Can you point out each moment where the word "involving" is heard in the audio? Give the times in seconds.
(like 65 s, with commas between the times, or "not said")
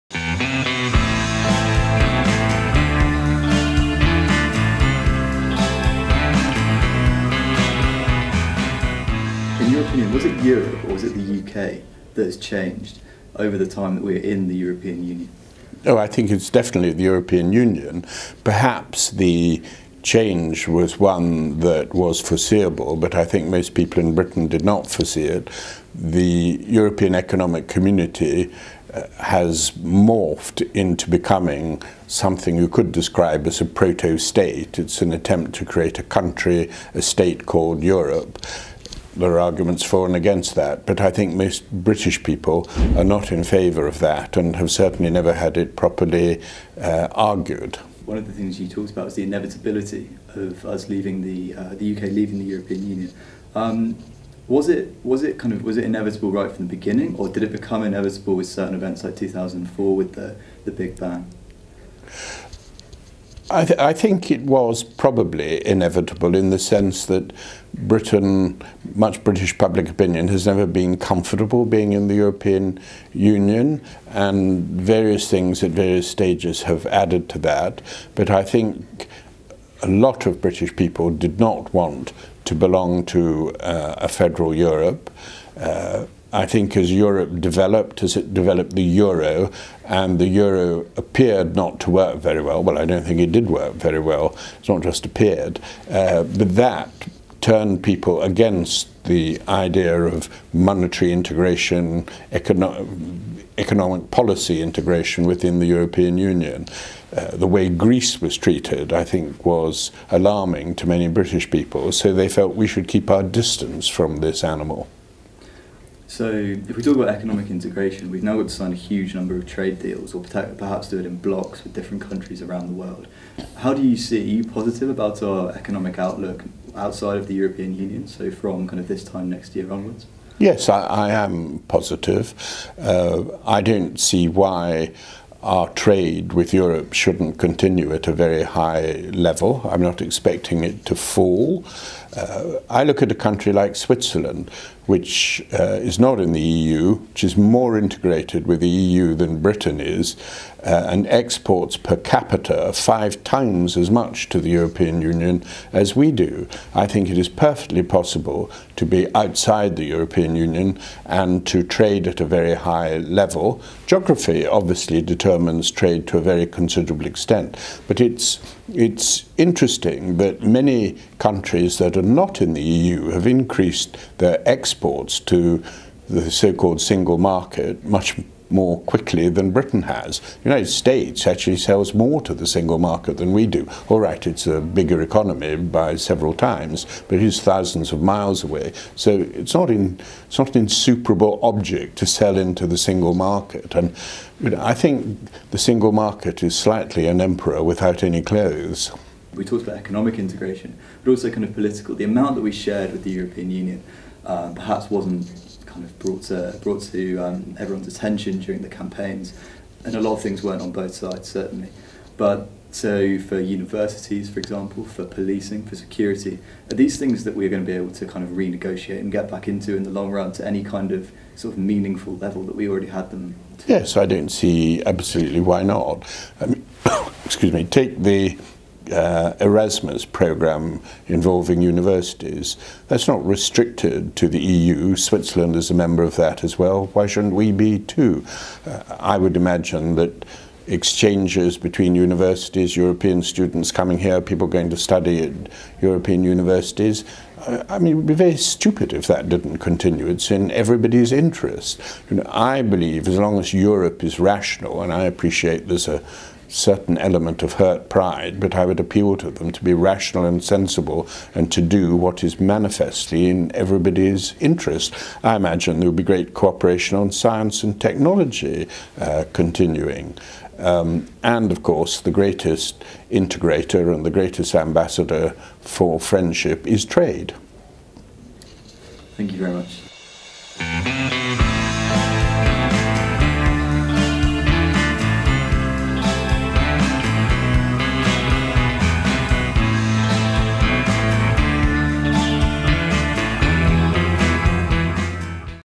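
231 s.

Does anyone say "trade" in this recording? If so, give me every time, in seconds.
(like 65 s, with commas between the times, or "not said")
119 s, 135 s, 161 s, 165 s, 276 s.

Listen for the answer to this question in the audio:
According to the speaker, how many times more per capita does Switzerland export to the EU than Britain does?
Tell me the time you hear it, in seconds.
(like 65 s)
152 s.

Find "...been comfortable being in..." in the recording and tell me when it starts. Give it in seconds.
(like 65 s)
70 s.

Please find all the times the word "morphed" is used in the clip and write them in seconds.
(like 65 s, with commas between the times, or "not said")
29 s.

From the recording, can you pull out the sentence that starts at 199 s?
we talked about economic integration, but also kind of political.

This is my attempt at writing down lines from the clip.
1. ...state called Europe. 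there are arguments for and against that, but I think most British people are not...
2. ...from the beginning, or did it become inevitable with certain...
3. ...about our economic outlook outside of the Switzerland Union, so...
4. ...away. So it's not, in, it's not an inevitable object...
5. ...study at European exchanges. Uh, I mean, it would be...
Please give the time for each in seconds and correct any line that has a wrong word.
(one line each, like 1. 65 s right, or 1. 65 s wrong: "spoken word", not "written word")
1. 37 s right
2. 56 s right
3. 124 s wrong: "European", not "Switzerland"
4. 188 s wrong: "insuperable", not "inevitable"
5. 244 s wrong: "universities", not "exchanges".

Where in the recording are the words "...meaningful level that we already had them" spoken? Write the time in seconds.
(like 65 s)
221 s.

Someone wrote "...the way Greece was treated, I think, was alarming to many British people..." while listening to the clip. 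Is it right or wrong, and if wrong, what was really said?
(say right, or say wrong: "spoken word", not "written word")
right.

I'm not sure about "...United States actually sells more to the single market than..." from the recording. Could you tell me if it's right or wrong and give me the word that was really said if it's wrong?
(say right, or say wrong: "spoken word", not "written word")
right.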